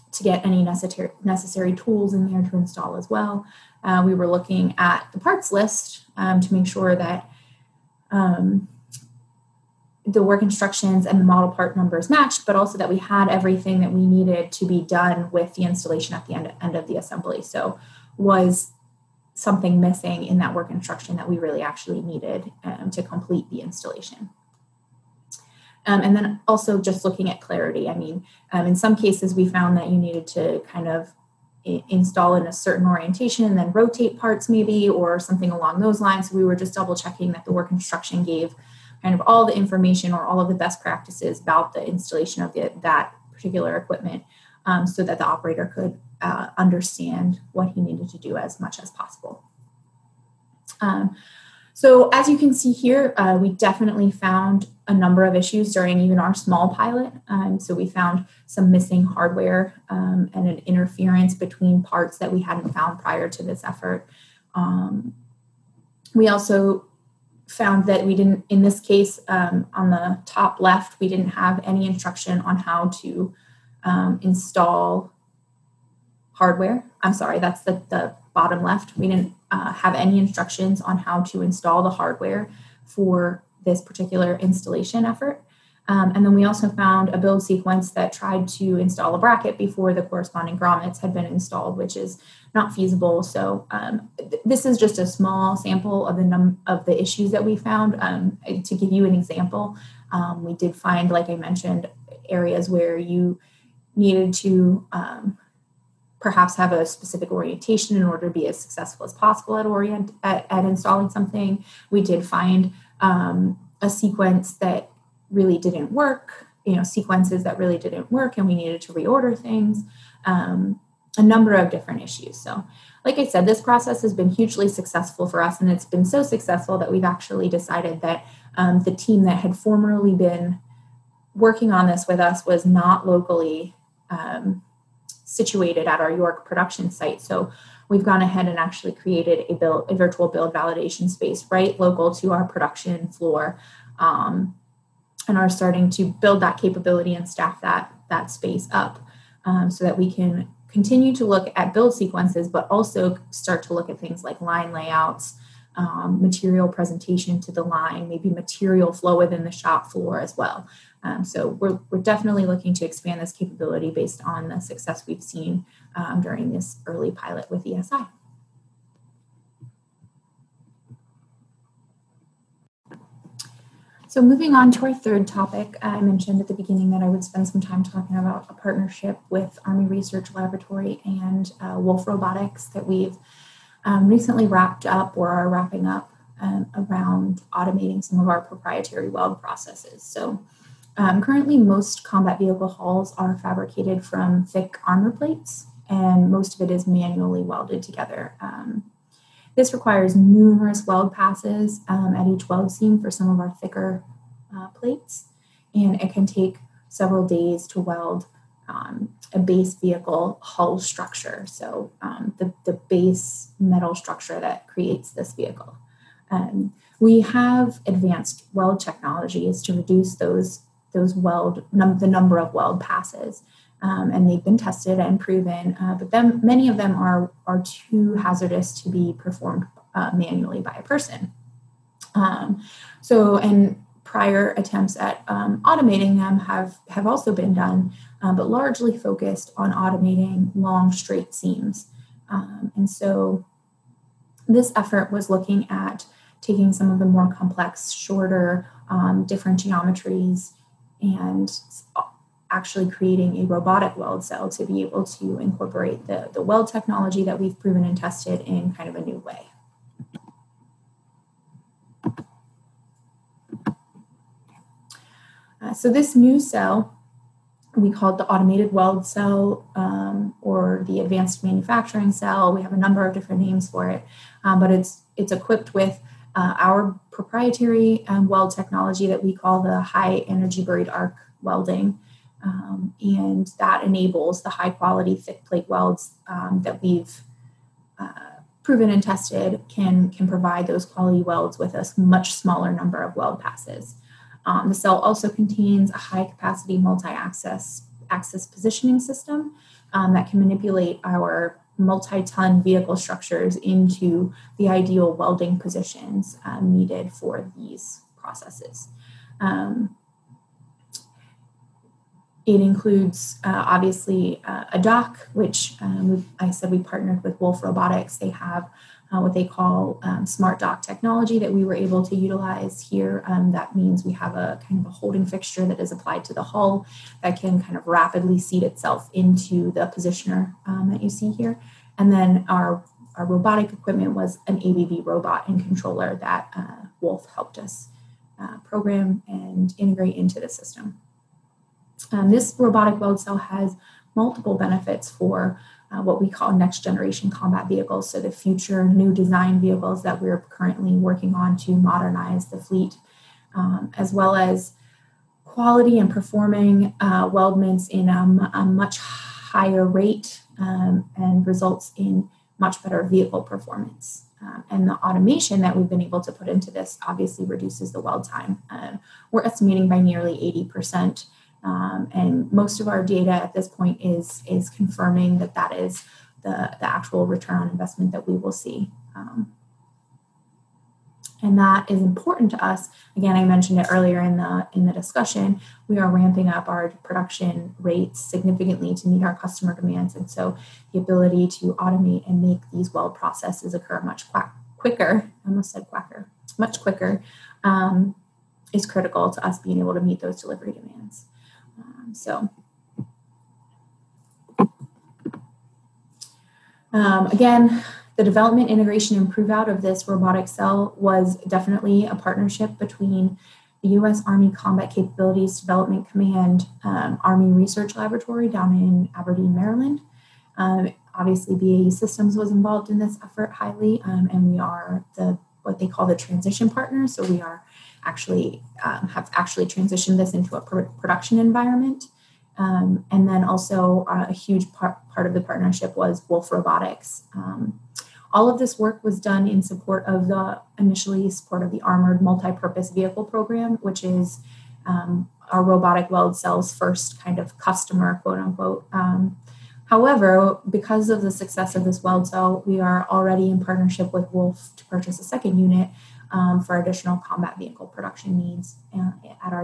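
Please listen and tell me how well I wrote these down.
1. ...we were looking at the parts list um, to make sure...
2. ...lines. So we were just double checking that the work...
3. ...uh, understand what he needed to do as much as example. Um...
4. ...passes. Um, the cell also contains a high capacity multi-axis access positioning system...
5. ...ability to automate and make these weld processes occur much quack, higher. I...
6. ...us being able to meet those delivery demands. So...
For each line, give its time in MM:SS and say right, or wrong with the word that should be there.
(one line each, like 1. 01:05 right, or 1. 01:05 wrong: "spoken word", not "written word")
1. 00:04 right
2. 00:36 right
3. 00:46 wrong: "possible", not "example"
4. 04:53 right
5. 06:30 wrong: "quicker", not "higher"
6. 06:39 right.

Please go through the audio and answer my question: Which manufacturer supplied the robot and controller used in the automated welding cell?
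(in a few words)
ABB.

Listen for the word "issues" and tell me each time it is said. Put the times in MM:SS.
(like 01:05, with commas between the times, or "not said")
00:55, 01:37, 02:02.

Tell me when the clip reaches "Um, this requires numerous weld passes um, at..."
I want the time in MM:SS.
03:18.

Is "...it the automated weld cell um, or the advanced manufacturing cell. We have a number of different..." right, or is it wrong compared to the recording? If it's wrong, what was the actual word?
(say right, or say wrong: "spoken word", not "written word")
right.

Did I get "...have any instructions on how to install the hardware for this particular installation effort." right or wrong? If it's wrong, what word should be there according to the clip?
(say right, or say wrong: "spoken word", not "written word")
right.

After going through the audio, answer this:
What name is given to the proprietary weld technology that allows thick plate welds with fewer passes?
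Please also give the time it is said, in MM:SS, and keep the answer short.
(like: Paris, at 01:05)
high energy buried arc welding, at 04:39.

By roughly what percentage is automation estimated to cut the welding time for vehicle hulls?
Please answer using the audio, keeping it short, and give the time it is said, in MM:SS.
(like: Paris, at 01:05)
80%, at 06:10.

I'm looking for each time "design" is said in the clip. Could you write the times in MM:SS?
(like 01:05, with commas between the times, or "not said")
05:49.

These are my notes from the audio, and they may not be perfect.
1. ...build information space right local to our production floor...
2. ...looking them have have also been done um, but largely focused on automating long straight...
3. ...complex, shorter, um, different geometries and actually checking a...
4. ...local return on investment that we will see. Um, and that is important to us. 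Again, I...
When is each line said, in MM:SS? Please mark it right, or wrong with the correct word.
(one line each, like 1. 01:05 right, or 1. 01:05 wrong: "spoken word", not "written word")
1. 02:20 wrong: "validation", not "information"
2. 03:55 wrong: "automating", not "looking"
3. 04:07 wrong: "creating", not "checking"
4. 06:16 wrong: "actual", not "local".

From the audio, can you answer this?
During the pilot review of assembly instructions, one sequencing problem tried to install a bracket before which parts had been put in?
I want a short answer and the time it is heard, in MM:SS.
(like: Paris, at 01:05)
grommets, at 01:30.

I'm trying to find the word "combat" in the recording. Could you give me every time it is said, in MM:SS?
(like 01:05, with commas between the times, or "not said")
03:12, 05:47, 06:54, 07:37.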